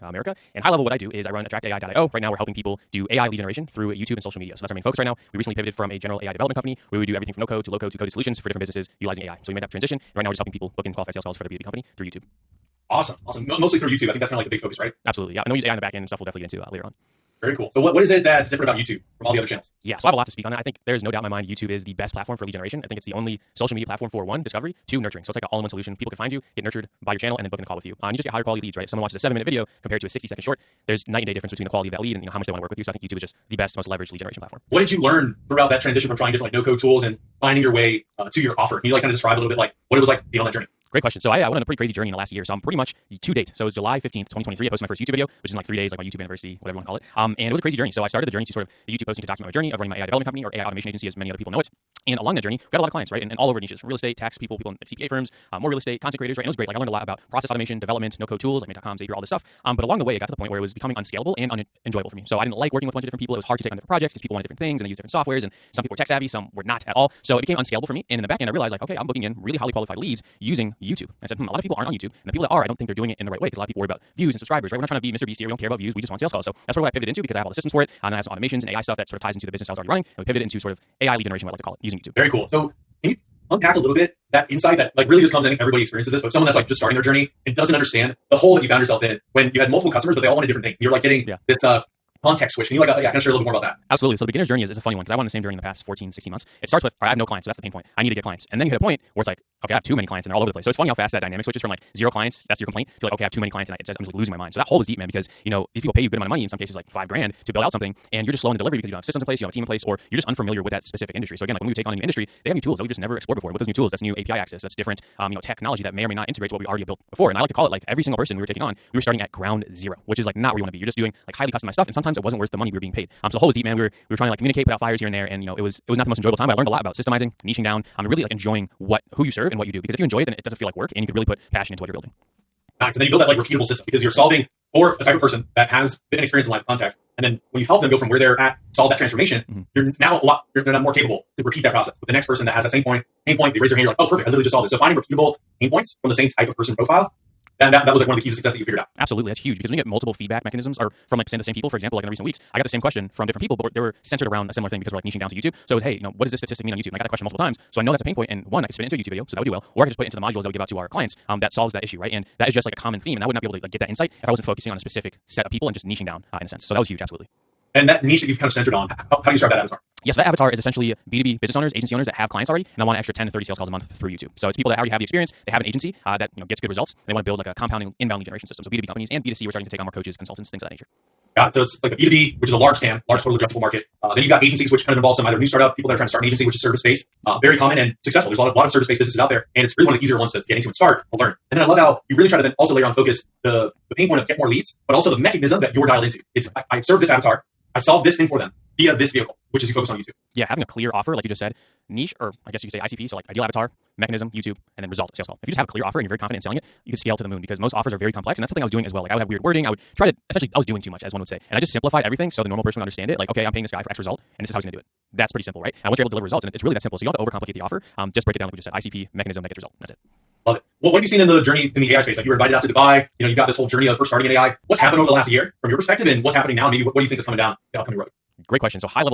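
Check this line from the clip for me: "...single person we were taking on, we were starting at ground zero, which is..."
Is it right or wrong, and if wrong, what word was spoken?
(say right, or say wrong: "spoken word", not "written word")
right.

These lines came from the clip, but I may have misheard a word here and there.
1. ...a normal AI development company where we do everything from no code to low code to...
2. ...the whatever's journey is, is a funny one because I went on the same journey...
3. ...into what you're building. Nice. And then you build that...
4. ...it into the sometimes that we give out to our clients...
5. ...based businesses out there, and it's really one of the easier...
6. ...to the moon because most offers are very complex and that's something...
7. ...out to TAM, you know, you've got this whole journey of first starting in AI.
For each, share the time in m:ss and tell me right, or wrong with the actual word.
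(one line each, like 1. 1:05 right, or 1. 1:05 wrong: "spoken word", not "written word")
1. 0:05 wrong: "general", not "normal"
2. 1:34 wrong: "beginner", not "whatever"
3. 2:11 right
4. 2:40 wrong: "modules", not "sometimes"
5. 3:08 right
6. 3:27 right
7. 3:42 wrong: "Dubai", not "TAM".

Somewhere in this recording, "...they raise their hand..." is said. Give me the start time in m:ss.
2:23.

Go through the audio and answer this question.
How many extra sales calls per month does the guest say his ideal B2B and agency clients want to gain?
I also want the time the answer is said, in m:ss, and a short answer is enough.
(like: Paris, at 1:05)
10 to 30, at 2:53.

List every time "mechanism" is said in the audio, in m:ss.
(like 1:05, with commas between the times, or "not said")
2:30, 3:15, 3:23, 3:39.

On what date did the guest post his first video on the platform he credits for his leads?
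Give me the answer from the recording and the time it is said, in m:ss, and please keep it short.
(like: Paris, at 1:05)
July 15th, 2023, at 0:43.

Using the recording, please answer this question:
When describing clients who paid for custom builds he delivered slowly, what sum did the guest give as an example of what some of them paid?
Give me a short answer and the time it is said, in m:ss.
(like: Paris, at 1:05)
5 grand, at 1:46.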